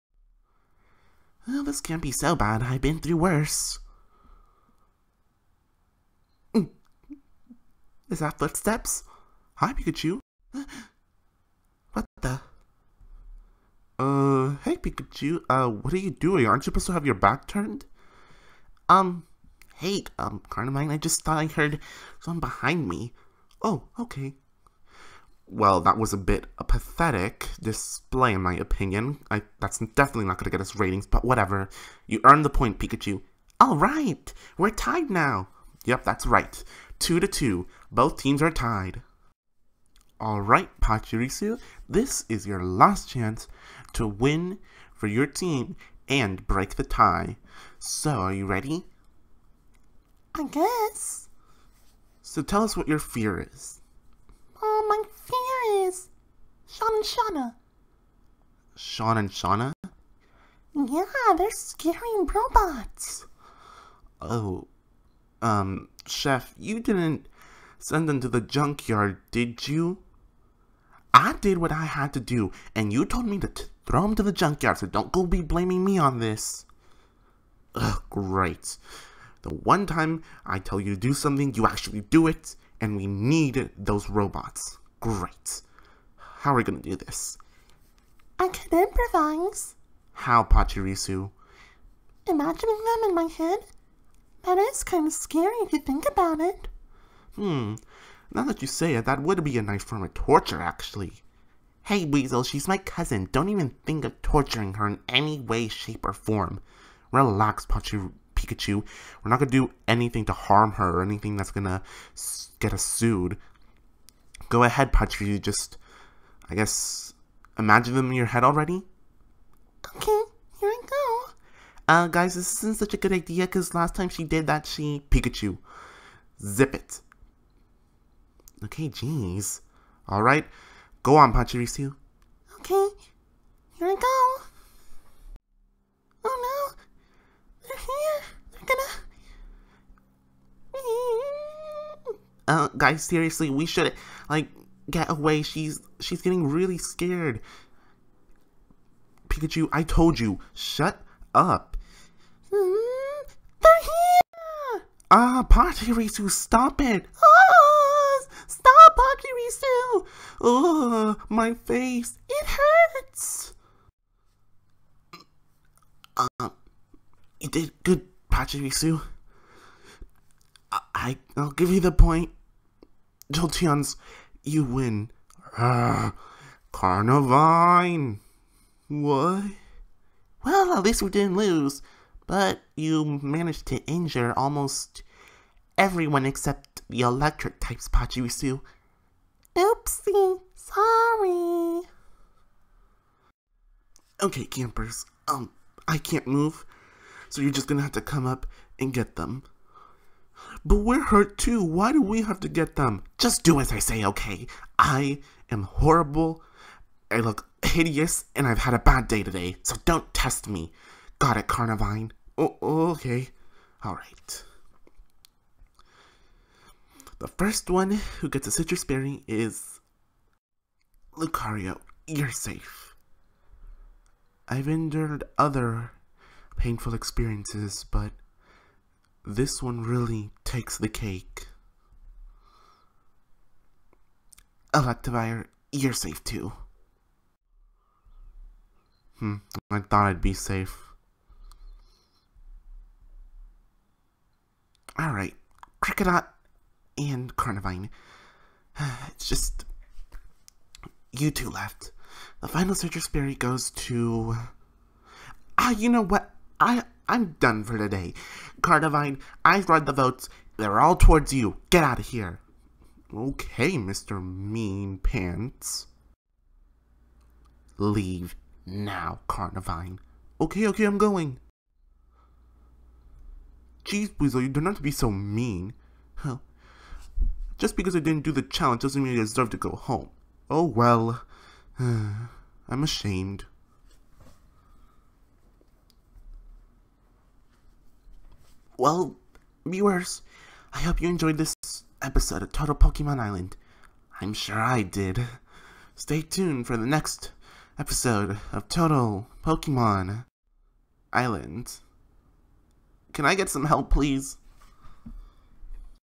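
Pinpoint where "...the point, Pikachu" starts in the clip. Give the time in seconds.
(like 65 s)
32 s.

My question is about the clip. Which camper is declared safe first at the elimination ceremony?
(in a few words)
Lucario.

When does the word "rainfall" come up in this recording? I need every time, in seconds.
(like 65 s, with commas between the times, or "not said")
not said.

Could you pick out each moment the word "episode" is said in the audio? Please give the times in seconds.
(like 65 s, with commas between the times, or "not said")
292 s, 297 s.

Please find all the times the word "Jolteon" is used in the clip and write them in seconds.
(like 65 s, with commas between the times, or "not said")
173 s.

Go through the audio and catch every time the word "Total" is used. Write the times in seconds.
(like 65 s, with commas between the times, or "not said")
292 s, 298 s.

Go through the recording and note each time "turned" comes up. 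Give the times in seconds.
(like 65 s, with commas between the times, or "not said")
17 s.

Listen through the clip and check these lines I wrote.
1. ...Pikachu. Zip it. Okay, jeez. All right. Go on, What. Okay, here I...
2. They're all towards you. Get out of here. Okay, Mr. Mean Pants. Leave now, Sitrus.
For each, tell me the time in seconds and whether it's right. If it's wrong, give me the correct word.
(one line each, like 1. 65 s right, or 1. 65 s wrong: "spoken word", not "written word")
1. 125 s wrong: "Pachirisu", not "What"
2. 260 s wrong: "Carnivine", not "Sitrus".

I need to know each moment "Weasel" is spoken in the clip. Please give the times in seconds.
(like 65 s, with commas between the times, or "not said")
102 s, 274 s.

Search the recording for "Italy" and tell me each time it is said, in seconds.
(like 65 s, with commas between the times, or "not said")
not said.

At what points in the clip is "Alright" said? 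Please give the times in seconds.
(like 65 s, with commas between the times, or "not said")
213 s, 244 s.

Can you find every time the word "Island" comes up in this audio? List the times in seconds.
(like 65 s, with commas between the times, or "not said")
293 s, 301 s.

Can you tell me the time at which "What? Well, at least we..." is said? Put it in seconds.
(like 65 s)
178 s.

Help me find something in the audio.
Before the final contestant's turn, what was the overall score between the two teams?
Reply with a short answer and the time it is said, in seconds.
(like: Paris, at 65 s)
2 to 2, at 36 s.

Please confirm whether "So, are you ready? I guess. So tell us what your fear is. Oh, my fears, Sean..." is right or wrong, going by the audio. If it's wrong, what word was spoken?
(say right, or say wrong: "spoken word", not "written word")
right.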